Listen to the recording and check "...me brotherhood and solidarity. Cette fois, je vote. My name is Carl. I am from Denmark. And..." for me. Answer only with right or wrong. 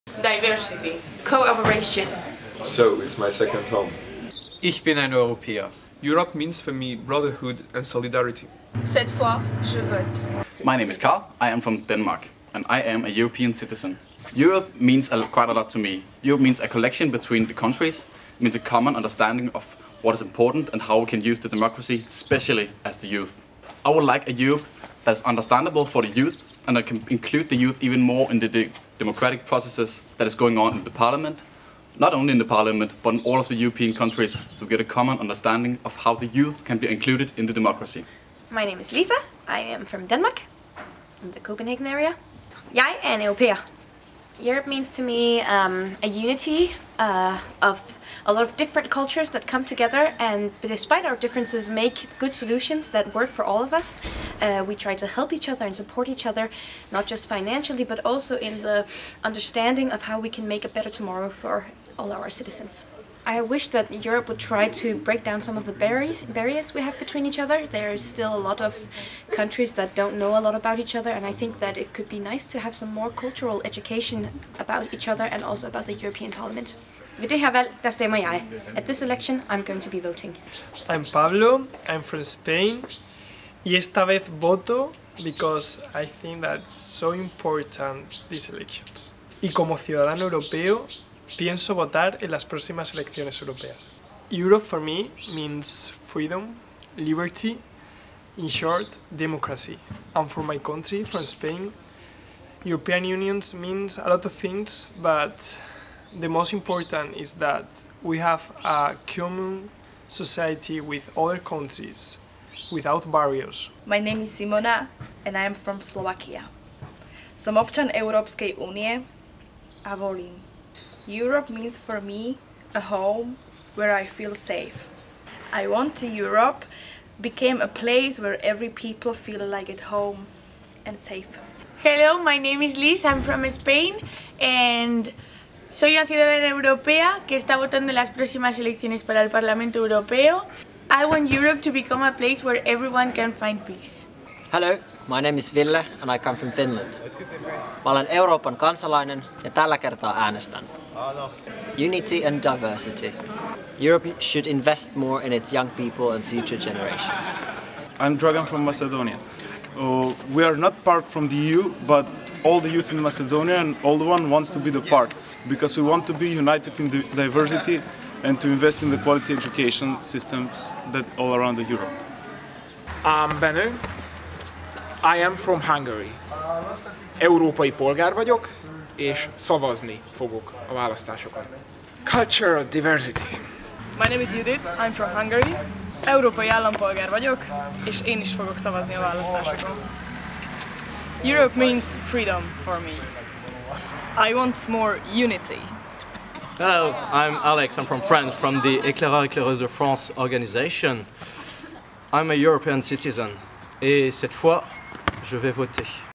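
right.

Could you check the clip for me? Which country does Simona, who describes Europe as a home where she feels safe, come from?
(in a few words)
Slovakia.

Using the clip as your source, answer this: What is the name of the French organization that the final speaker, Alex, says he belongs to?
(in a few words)
Éclaireurs Éclaireuses de France.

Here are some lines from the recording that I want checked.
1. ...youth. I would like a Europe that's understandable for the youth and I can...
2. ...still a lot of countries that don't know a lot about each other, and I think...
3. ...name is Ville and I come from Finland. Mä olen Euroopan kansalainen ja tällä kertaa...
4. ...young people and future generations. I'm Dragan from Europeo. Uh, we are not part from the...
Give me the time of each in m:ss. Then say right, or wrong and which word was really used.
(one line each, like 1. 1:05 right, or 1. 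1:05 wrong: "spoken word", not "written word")
1. 0:23 right
2. 1:07 right
3. 2:25 right
4. 2:35 wrong: "Macedonia", not "Europeo".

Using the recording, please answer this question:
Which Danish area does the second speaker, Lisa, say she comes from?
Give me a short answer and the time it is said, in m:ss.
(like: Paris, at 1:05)
Copenhagen, at 0:41.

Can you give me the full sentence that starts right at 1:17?
At this election, I'm going to be voting.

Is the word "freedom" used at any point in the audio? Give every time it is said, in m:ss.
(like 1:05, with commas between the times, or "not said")
1:35, 3:12.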